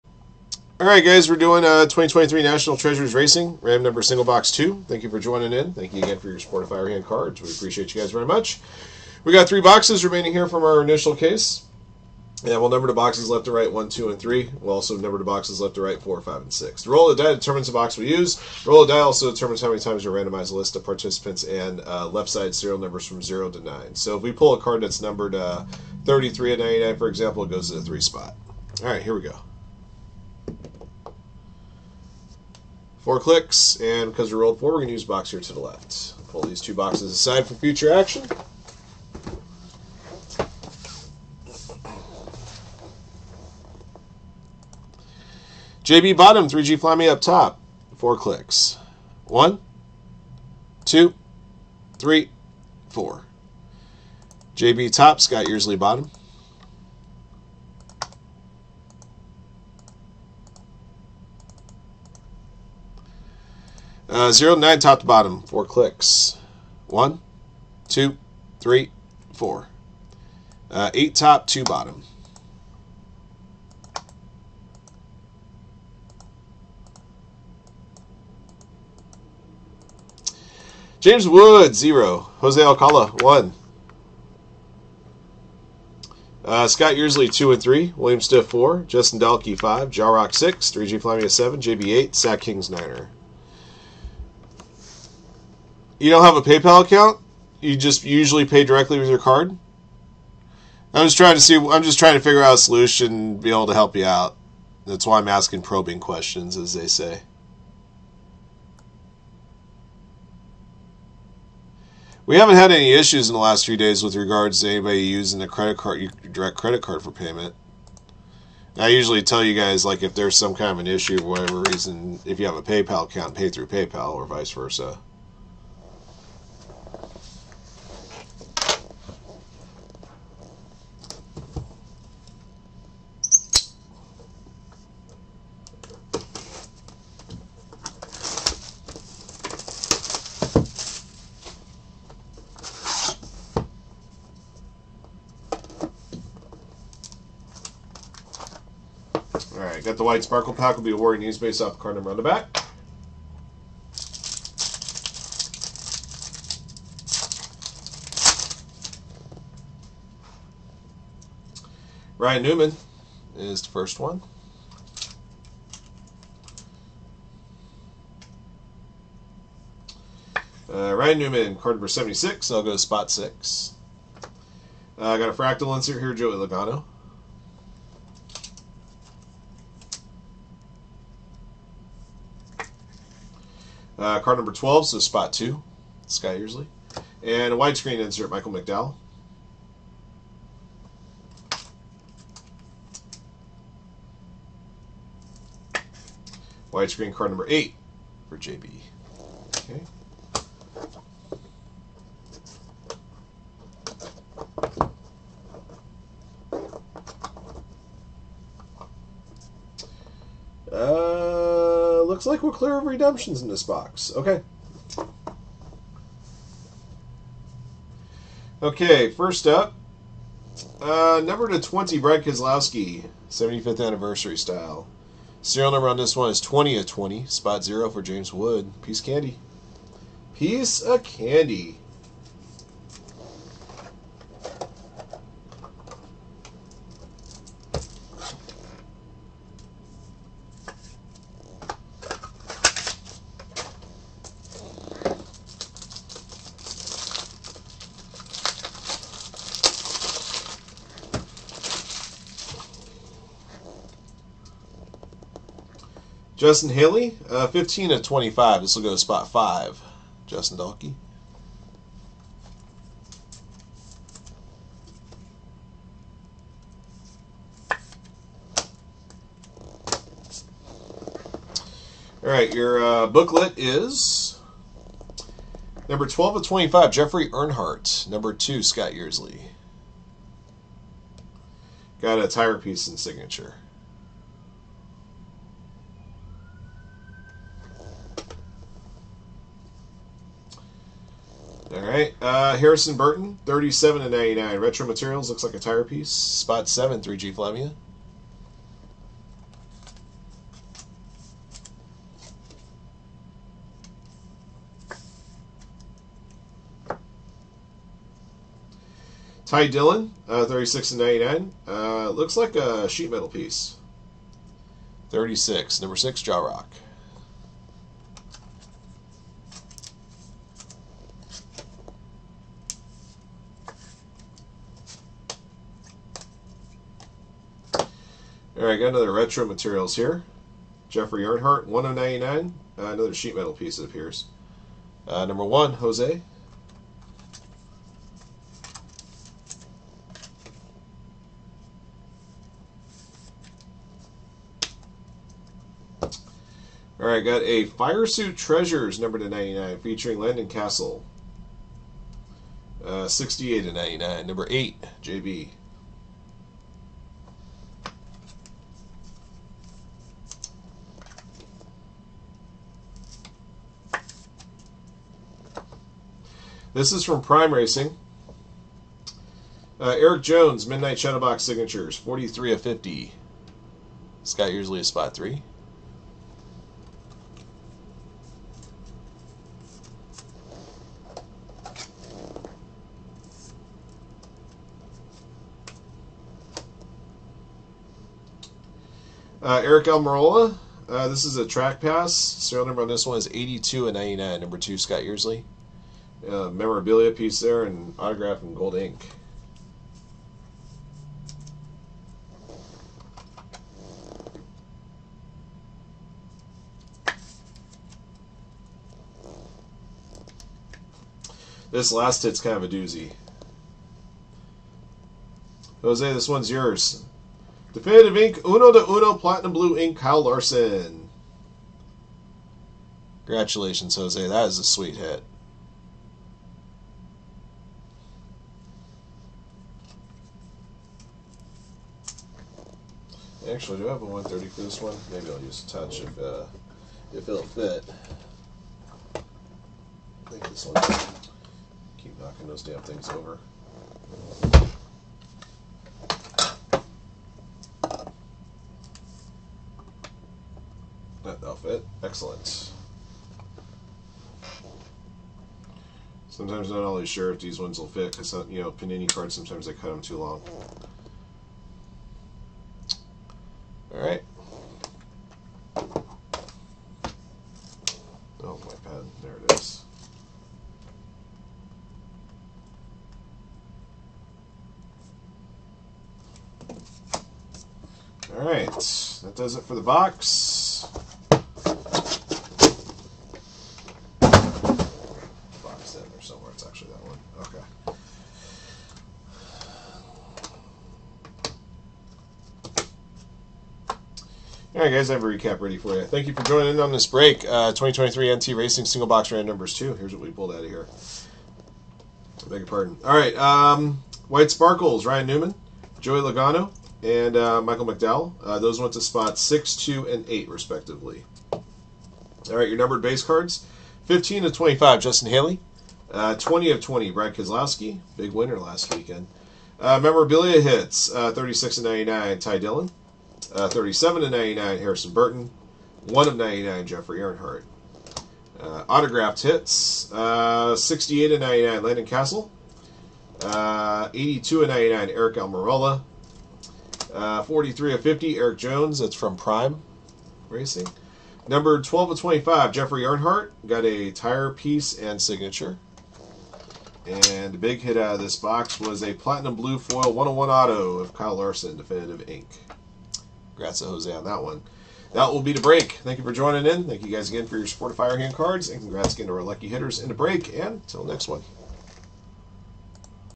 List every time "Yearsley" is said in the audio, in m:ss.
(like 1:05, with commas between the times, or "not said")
0:55, 1:26, 3:06, 4:38, 6:35.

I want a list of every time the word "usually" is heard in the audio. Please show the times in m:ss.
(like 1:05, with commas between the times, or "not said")
1:38, 1:58, 6:14.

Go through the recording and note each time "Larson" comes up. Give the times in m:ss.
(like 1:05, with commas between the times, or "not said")
7:00, 9:11.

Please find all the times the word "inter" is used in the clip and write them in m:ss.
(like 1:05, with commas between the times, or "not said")
not said.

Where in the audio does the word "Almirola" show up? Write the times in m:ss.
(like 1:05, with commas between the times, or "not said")
6:29, 8:55.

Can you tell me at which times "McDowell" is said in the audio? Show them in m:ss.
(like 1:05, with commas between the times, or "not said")
3:08, 8:27.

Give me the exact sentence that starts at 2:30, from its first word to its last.
Will be awarding these based base off card number on the back.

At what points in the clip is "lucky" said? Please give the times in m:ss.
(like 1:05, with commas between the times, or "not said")
9:19.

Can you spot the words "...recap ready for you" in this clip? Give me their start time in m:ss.
8:15.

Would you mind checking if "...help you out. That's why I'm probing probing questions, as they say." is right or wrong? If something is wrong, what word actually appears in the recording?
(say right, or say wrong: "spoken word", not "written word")
wrong: "asking", not "probing".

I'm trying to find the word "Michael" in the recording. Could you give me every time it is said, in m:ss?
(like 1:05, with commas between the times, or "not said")
3:08, 8:27.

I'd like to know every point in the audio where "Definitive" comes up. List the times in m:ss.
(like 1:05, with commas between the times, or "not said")
6:57, 9:11.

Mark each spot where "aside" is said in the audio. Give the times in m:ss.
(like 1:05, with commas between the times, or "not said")
0:37.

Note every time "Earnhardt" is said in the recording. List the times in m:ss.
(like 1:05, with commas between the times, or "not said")
4:37, 5:31, 8:47, 9:03.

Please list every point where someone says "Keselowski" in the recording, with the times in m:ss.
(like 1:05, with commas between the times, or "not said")
3:42, 8:37.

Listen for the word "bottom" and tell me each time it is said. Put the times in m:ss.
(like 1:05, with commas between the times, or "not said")
0:46, 0:55, 1:05, 1:11.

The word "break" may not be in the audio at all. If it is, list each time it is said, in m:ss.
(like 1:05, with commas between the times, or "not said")
8:17, 9:15, 9:20.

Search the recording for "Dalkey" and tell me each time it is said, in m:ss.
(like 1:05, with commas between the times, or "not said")
1:29, 4:20.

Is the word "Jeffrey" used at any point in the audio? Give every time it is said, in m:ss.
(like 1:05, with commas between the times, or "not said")
4:36, 5:30, 8:46, 9:02.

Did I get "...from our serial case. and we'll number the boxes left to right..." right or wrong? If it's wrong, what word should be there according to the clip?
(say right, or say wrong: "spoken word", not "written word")
wrong: "initial", not "serial".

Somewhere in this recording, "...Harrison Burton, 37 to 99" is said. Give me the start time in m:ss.
4:52.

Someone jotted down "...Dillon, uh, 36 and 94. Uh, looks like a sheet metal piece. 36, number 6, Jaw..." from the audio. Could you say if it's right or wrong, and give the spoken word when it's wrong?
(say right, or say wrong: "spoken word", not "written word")
wrong: "99", not "94".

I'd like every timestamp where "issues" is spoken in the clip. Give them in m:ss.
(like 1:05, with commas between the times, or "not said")
1:52, 2:00.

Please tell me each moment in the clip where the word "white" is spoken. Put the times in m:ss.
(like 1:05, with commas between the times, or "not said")
2:30, 8:24.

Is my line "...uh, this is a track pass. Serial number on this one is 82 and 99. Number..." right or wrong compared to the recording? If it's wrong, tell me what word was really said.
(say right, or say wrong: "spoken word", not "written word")
right.